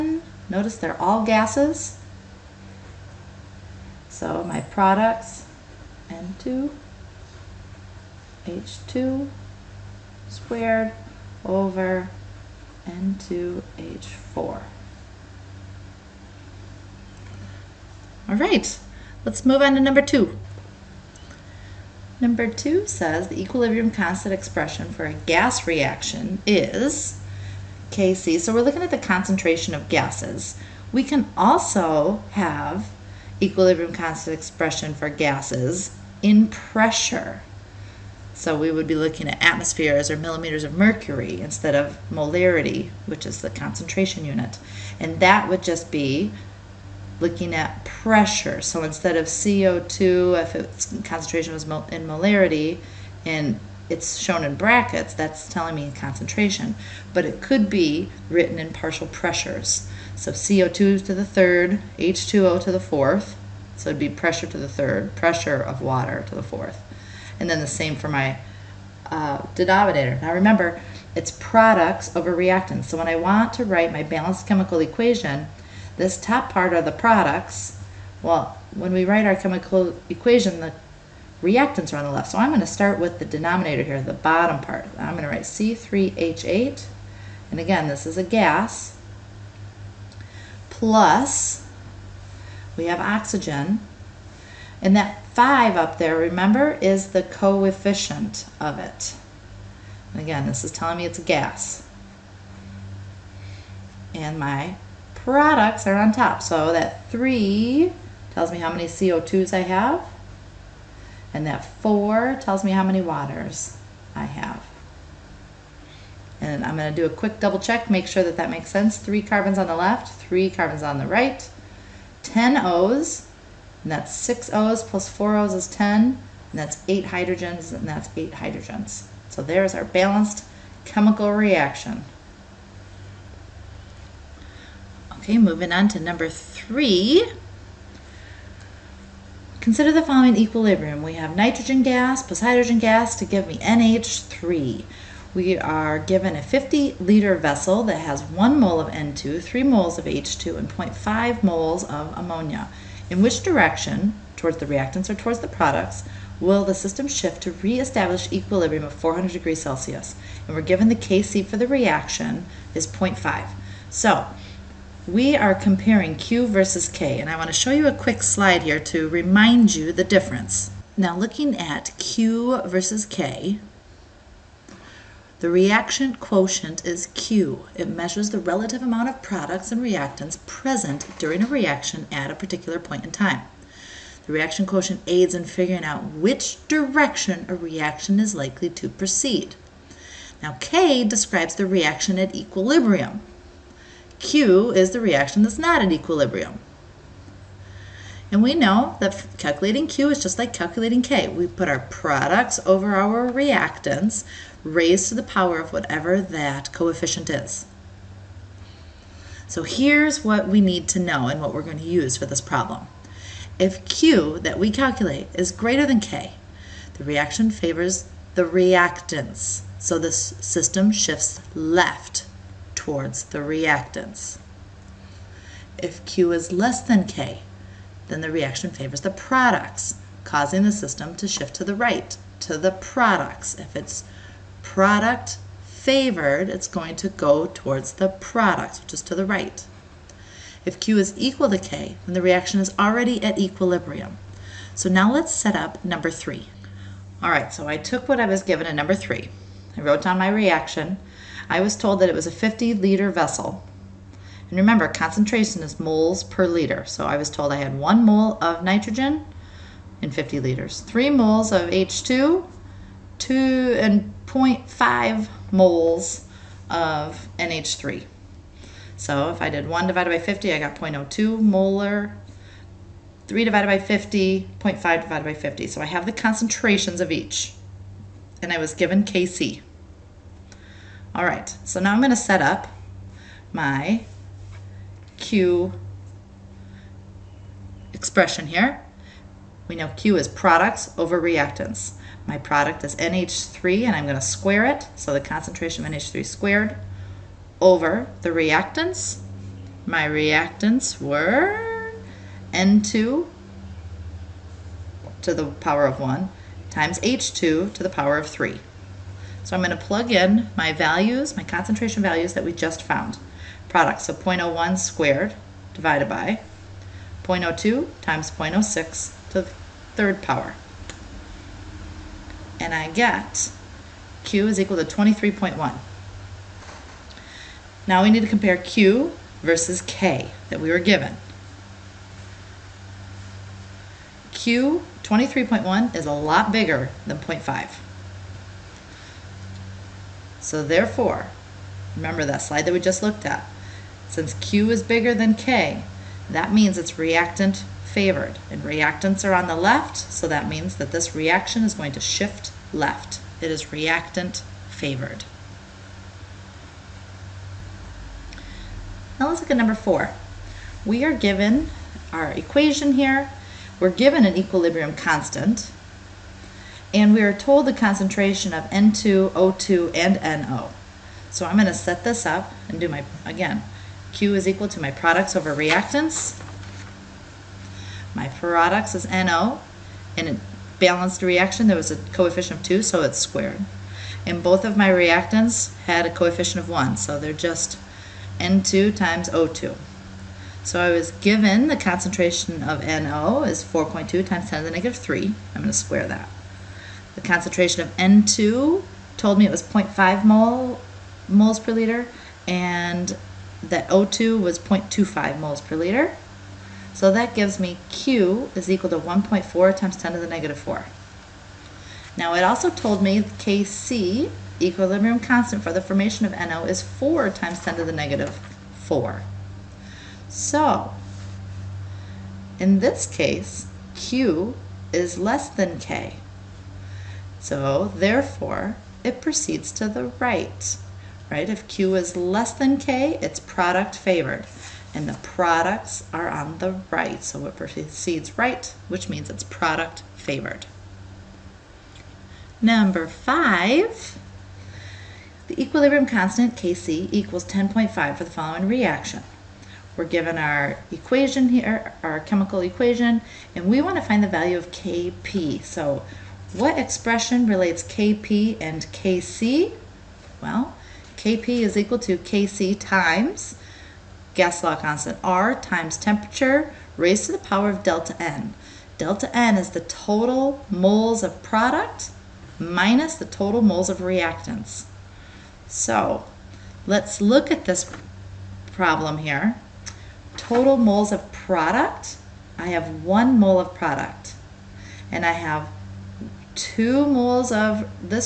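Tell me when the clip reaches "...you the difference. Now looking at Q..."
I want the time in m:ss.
2:49.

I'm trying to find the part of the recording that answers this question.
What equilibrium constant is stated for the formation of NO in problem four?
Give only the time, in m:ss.
6:56.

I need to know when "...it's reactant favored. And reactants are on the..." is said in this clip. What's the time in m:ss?
5:46.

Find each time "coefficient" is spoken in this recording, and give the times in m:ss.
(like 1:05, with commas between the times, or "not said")
1:37, 3:26, 6:21, 6:26.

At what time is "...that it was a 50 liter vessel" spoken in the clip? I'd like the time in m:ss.
4:11.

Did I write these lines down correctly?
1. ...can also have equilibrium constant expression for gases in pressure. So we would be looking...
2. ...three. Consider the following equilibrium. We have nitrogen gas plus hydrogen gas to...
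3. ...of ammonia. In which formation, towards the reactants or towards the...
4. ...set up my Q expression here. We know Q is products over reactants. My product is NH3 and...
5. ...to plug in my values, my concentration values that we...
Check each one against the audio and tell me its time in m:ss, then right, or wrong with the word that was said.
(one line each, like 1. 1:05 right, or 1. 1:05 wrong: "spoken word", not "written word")
1. 0:31 right
2. 2:16 right
3. 2:31 wrong: "direction", not "formation"
4. 4:42 right
5. 5:09 right.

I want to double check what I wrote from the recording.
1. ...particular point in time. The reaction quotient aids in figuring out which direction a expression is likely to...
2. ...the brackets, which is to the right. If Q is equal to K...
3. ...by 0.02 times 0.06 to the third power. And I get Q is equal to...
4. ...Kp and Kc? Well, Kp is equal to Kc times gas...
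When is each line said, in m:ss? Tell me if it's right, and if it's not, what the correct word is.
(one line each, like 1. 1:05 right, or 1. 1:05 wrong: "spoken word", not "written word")
1. 3:02 wrong: "reaction", not "expression"
2. 3:57 wrong: "products", not "brackets"
3. 5:16 right
4. 7:37 right.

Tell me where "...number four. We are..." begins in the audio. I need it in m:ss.
5:59.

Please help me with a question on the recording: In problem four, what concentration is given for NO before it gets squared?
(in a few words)
4.2 times 10 to the negative 3.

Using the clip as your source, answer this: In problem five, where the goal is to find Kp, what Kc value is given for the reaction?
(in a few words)
10.5.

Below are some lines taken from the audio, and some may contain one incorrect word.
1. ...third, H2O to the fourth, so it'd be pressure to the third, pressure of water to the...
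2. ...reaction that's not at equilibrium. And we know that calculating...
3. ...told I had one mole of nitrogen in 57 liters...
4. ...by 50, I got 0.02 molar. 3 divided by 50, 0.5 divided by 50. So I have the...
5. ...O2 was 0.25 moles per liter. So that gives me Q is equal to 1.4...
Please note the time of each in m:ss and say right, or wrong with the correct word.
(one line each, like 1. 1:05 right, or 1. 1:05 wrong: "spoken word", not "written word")
1. 1:01 right
2. 3:15 right
3. 4:17 wrong: "50", not "57"
4. 4:30 right
5. 6:43 right.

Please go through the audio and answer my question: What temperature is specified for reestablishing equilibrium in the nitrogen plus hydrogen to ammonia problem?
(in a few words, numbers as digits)
400 degrees Celsius.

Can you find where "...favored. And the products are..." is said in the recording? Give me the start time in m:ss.
7:13.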